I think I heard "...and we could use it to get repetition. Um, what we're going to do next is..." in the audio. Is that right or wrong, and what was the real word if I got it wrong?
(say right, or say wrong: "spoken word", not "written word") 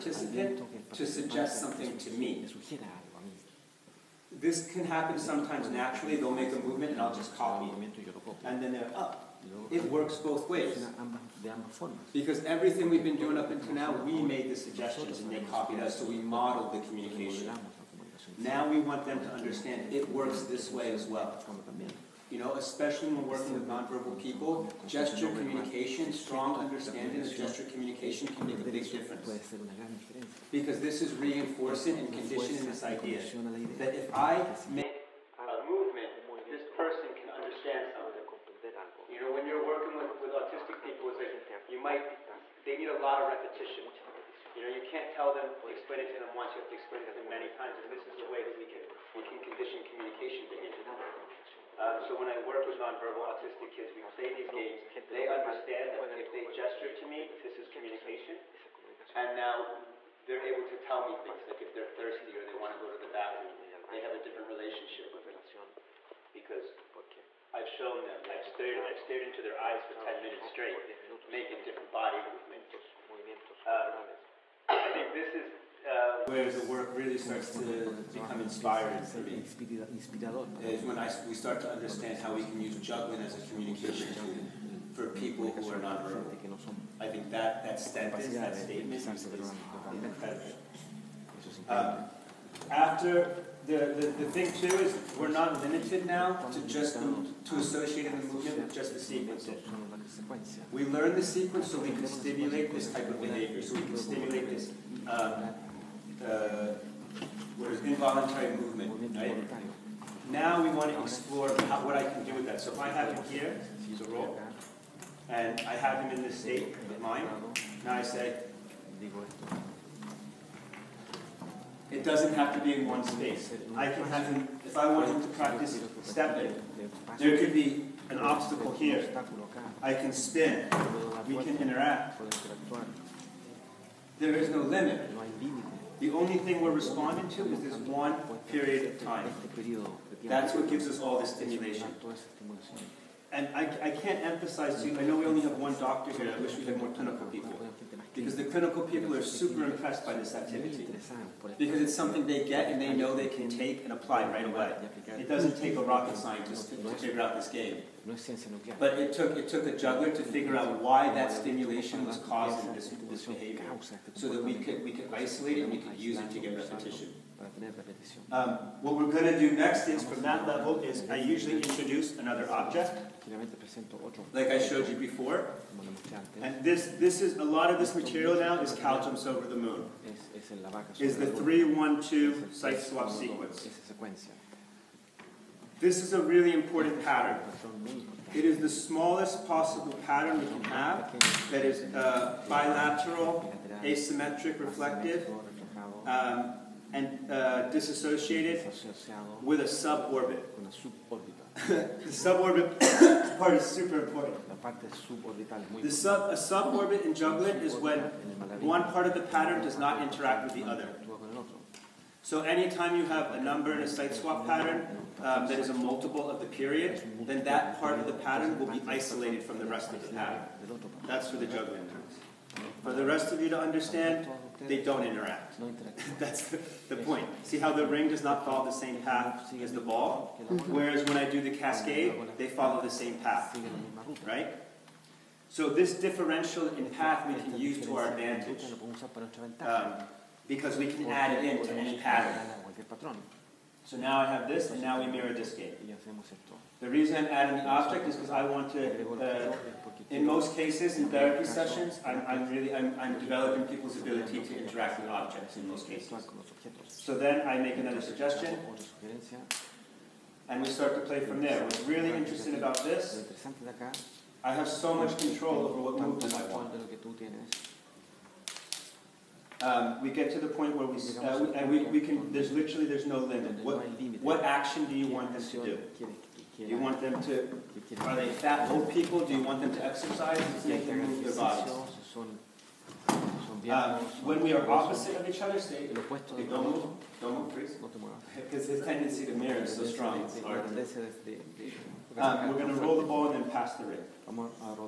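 right.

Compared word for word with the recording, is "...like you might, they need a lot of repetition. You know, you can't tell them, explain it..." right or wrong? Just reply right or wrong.
right.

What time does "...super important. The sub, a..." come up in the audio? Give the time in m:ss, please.
3:23.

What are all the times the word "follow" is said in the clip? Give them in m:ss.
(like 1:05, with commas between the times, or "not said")
3:48, 3:52.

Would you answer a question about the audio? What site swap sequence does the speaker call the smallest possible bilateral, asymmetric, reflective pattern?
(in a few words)
312.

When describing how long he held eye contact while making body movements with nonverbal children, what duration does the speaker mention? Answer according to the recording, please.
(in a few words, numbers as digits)
10 minutes.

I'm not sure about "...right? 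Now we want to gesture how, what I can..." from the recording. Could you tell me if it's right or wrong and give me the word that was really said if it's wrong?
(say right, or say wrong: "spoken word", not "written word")
wrong: "explore", not "gesture".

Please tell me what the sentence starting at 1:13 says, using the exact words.
Um, I think this is uh, where the work really starts to become inspiring for me.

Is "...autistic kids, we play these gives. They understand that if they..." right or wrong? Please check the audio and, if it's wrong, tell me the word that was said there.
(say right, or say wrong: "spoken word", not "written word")
wrong: "games", not "gives".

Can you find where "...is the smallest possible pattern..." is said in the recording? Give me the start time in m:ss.
3:08.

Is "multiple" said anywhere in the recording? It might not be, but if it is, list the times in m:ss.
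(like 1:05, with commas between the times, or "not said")
3:35.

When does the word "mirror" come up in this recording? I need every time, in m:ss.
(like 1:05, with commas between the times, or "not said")
4:05, 4:49.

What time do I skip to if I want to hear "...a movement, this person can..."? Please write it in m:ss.
0:35.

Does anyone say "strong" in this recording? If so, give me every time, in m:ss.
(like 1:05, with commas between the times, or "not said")
0:26, 4:49.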